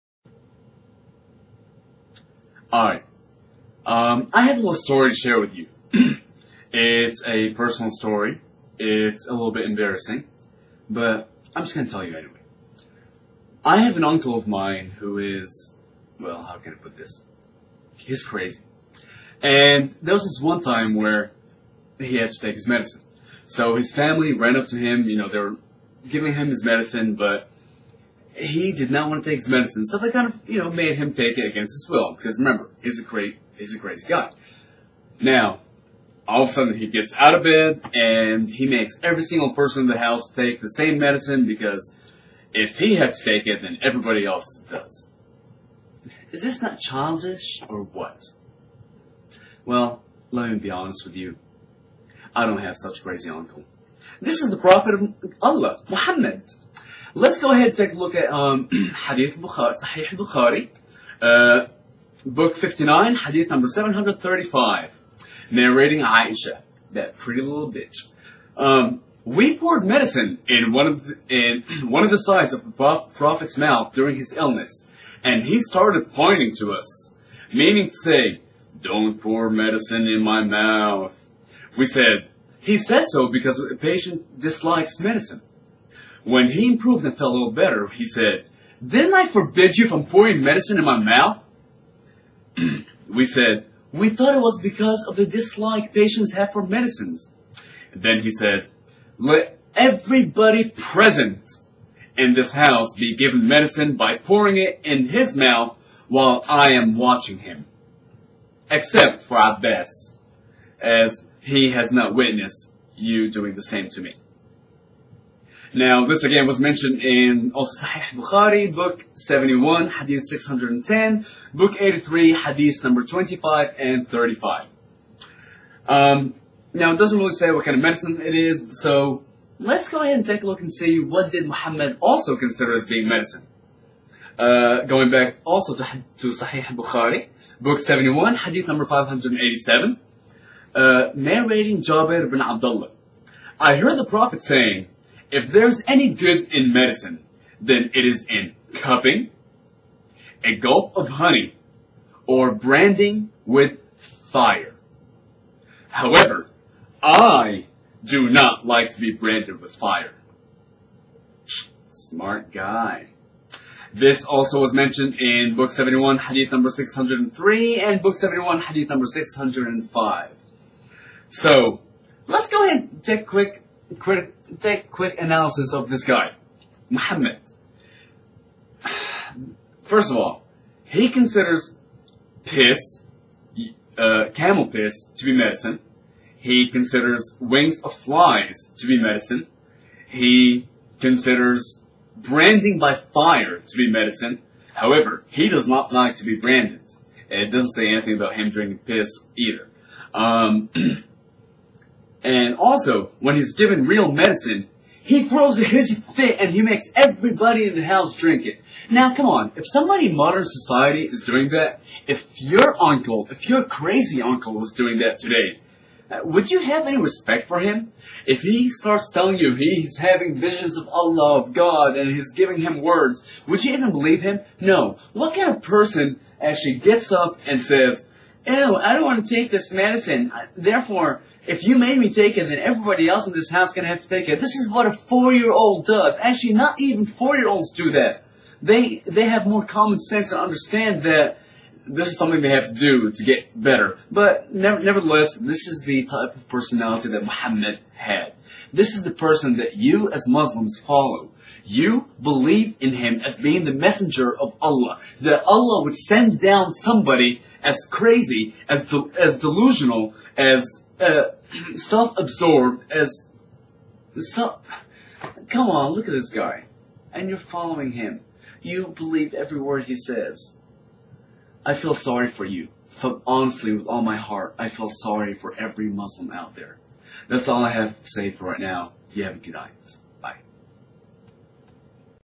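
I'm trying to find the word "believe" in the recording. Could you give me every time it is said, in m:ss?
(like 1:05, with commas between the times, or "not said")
3:43, 4:12, 4:28.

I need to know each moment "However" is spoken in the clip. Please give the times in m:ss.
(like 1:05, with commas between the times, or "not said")
2:35, 3:14.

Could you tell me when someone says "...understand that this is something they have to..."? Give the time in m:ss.
4:00.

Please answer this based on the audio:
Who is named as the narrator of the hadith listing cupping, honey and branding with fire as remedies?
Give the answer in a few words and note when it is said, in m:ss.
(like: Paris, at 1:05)
Jabir bin Abdullah, at 2:21.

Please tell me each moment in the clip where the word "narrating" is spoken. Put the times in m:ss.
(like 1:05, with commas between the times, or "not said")
1:05, 2:21.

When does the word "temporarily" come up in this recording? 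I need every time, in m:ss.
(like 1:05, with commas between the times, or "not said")
not said.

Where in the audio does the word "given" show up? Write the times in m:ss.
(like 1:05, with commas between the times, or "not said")
1:43, 3:23.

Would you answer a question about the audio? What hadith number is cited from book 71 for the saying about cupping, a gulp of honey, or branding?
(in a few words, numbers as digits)
587.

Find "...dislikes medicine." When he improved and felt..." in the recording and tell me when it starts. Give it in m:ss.
1:24.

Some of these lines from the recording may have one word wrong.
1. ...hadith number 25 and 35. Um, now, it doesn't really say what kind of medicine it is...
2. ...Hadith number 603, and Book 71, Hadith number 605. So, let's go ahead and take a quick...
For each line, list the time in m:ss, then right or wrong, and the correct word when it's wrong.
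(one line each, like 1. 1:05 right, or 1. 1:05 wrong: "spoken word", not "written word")
1. 2:02 right
2. 2:46 right.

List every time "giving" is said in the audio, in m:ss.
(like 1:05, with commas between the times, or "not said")
0:26, 3:42.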